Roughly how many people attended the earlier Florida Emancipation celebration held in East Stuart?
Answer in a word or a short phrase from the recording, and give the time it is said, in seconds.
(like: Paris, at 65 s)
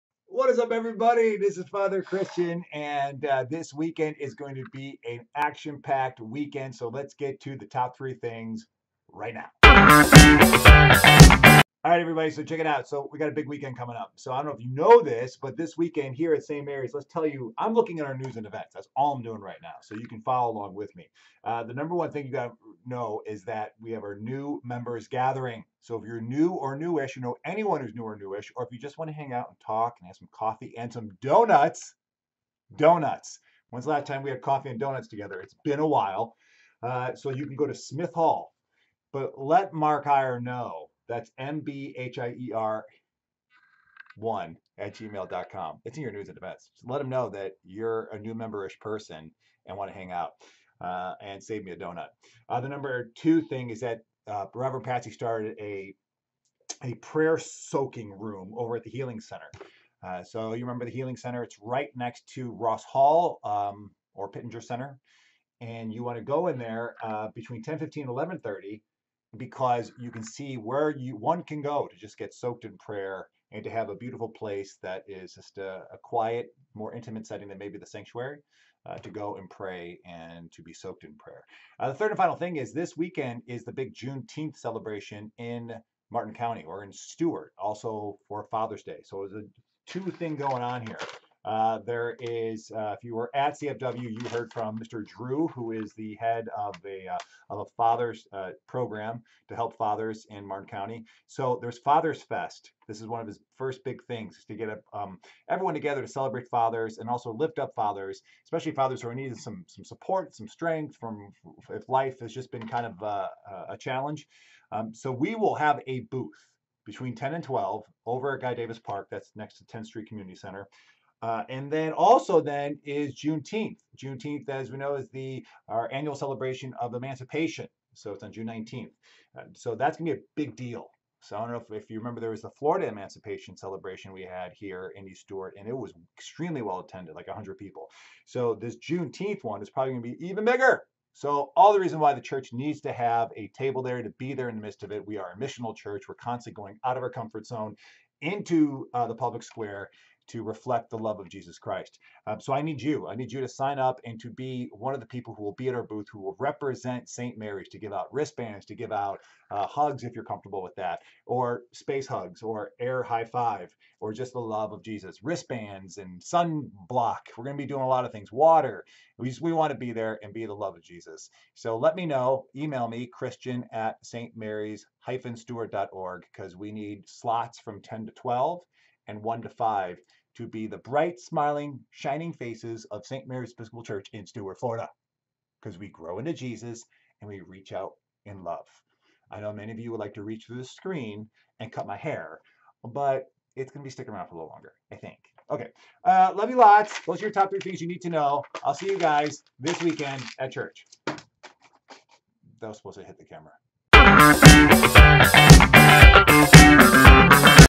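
100, at 137 s.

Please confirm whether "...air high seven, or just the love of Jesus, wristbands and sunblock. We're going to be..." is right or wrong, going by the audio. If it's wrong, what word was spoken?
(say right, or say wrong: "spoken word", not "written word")
wrong: "five", not "seven".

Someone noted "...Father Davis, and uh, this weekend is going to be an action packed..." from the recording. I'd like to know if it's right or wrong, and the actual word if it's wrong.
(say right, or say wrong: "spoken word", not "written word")
wrong: "Christian", not "Davis".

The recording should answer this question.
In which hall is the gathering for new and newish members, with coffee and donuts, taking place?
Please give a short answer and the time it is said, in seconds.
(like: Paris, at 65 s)
Smith Hall, at 37 s.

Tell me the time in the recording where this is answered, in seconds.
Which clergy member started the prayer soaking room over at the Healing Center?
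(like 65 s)
54 s.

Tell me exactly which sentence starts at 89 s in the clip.
So it's a two thing going on here.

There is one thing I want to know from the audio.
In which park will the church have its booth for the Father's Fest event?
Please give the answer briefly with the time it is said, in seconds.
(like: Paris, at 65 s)
Guy Davis Park, at 118 s.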